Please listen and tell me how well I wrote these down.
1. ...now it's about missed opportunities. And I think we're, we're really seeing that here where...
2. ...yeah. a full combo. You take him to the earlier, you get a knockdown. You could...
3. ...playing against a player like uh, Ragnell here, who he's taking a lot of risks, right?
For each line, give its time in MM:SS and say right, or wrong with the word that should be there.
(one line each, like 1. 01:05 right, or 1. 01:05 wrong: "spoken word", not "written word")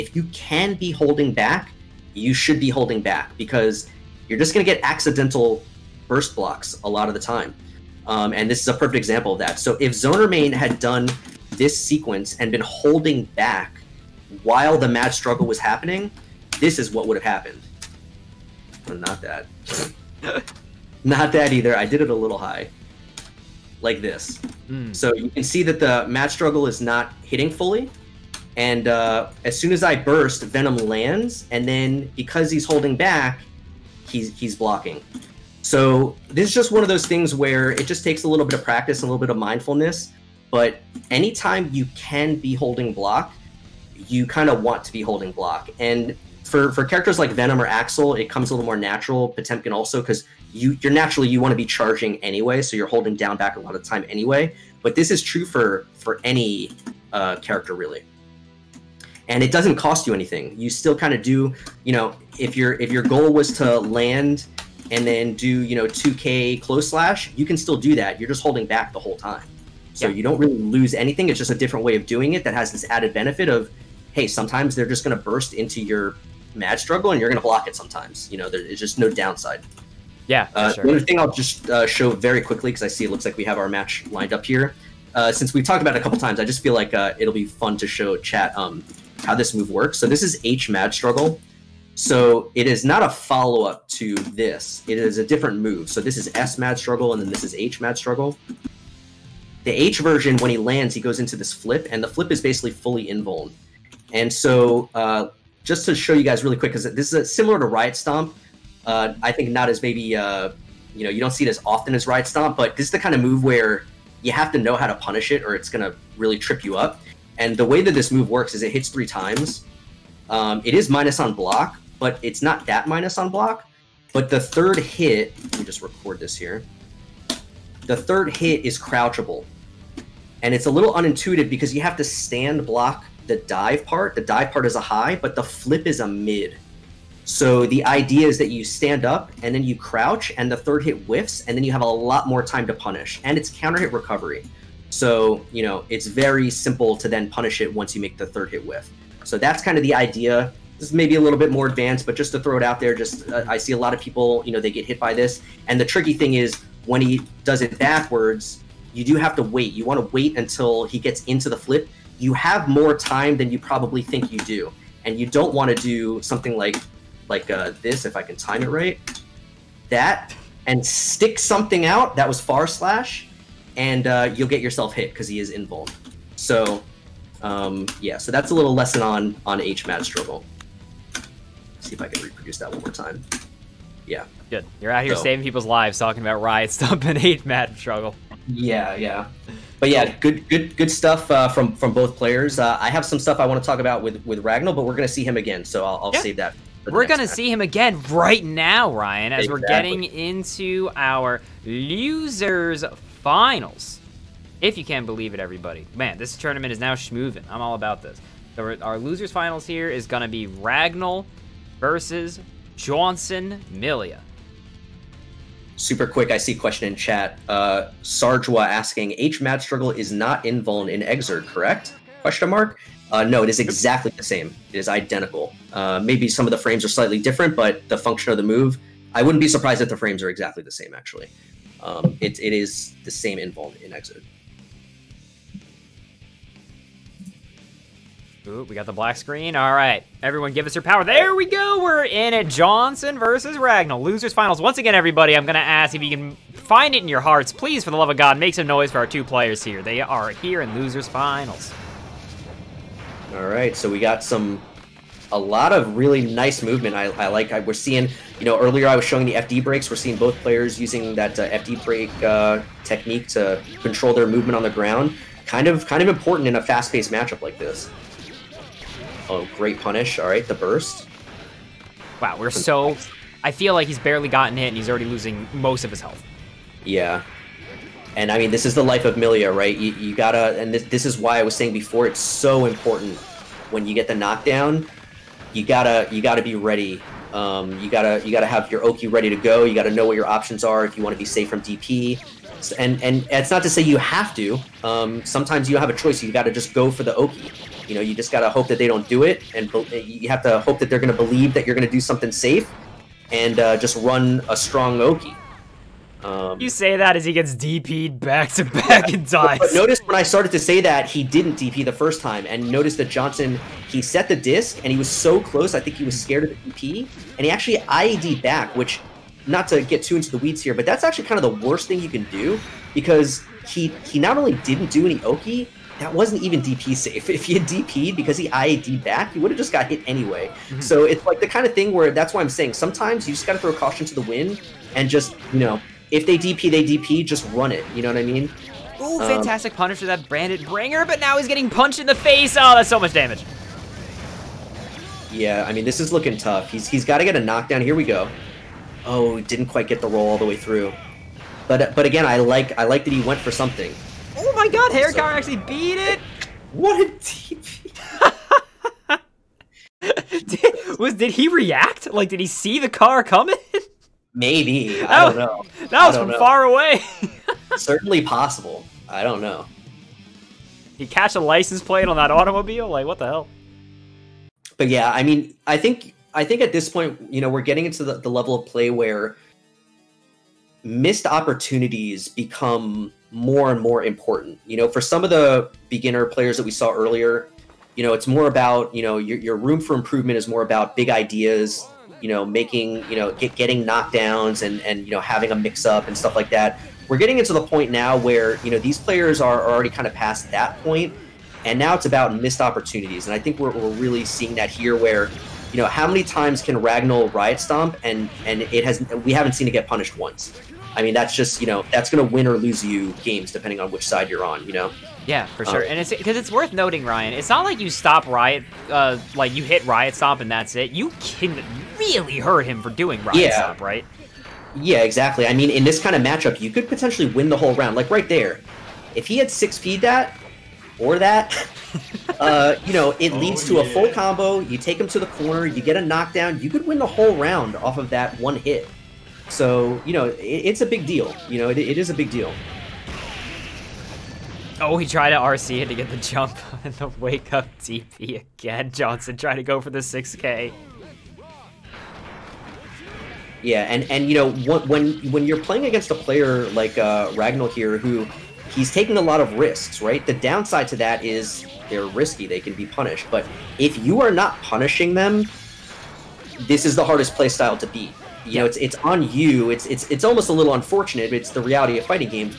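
1. 06:41 right
2. 07:13 wrong: "corner", not "earlier"
3. 07:35 right.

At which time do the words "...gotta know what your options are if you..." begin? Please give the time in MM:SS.
04:49.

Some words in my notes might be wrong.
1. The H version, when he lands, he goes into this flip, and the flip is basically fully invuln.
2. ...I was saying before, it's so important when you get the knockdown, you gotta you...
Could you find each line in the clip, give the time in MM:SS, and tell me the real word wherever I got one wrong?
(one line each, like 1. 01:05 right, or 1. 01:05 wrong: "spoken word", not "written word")
1. 01:39 right
2. 04:41 right.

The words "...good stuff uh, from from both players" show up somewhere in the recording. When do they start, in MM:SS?
03:10.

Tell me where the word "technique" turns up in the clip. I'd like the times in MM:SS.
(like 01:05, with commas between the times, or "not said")
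04:22.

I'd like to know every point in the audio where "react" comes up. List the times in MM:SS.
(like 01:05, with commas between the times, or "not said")
06:01.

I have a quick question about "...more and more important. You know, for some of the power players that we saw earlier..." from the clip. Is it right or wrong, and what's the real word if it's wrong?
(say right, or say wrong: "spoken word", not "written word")
wrong: "beginner", not "power".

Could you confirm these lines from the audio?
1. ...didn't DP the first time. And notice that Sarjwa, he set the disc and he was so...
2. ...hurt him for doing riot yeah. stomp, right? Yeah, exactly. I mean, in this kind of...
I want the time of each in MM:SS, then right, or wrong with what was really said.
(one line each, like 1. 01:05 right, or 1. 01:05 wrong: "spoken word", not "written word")
1. 05:11 wrong: "Jawnsunn", not "Sarjwa"
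2. 07:02 right.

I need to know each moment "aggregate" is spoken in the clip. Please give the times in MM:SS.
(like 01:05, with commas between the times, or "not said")
not said.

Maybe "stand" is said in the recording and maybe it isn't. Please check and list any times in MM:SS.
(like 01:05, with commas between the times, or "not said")
02:12, 02:18.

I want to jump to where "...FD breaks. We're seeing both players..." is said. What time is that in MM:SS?
04:19.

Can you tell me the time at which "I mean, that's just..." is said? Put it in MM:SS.
06:50.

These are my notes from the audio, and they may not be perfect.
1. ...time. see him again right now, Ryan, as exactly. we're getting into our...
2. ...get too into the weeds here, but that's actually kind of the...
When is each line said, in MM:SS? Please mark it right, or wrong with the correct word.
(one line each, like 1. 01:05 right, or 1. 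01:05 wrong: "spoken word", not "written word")
1. 03:17 right
2. 05:19 right.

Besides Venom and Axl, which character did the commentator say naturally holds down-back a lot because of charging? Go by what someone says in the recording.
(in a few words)
Potemkin.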